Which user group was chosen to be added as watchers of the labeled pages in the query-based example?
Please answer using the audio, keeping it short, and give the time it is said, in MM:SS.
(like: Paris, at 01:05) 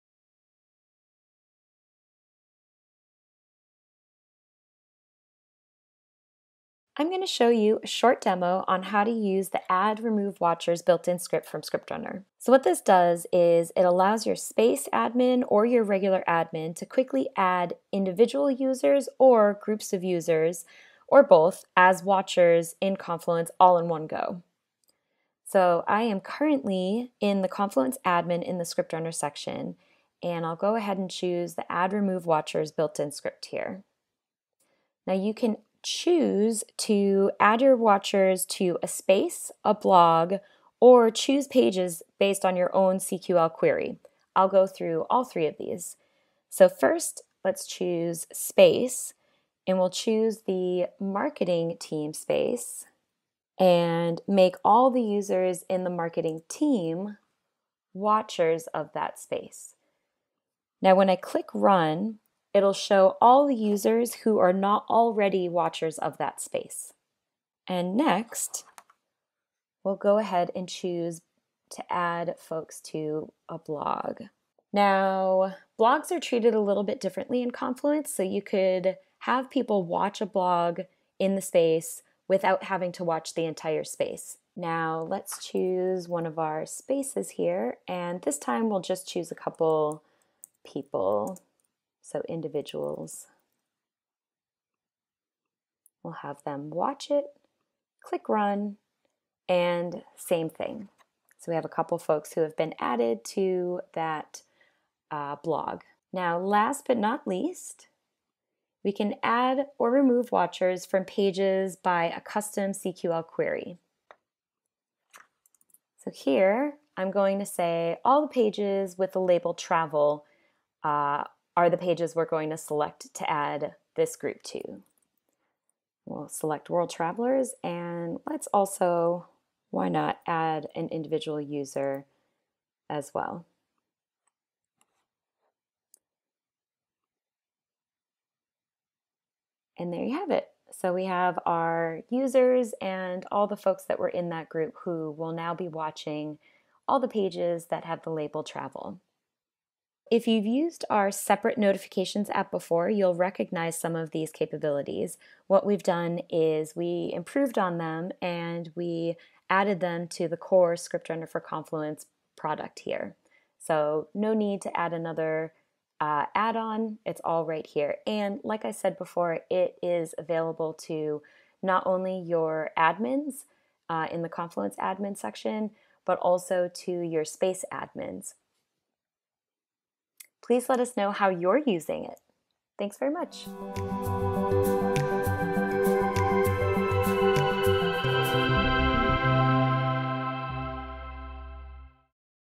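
World Travelers, at 02:06.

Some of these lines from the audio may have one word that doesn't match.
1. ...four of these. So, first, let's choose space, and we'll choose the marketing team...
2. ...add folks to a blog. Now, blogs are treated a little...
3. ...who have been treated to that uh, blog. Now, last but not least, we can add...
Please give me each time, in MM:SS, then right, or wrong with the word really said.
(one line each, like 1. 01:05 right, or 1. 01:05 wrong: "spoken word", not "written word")
1. 00:45 wrong: "three", not "four"
2. 01:11 right
3. 01:42 wrong: "added", not "treated".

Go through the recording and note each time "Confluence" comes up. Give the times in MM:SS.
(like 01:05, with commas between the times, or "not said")
00:22, 00:27, 01:17, 02:41, 02:54.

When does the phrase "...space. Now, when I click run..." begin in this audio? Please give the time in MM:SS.
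00:59.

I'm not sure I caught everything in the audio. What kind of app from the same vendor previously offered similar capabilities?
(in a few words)
notifications app.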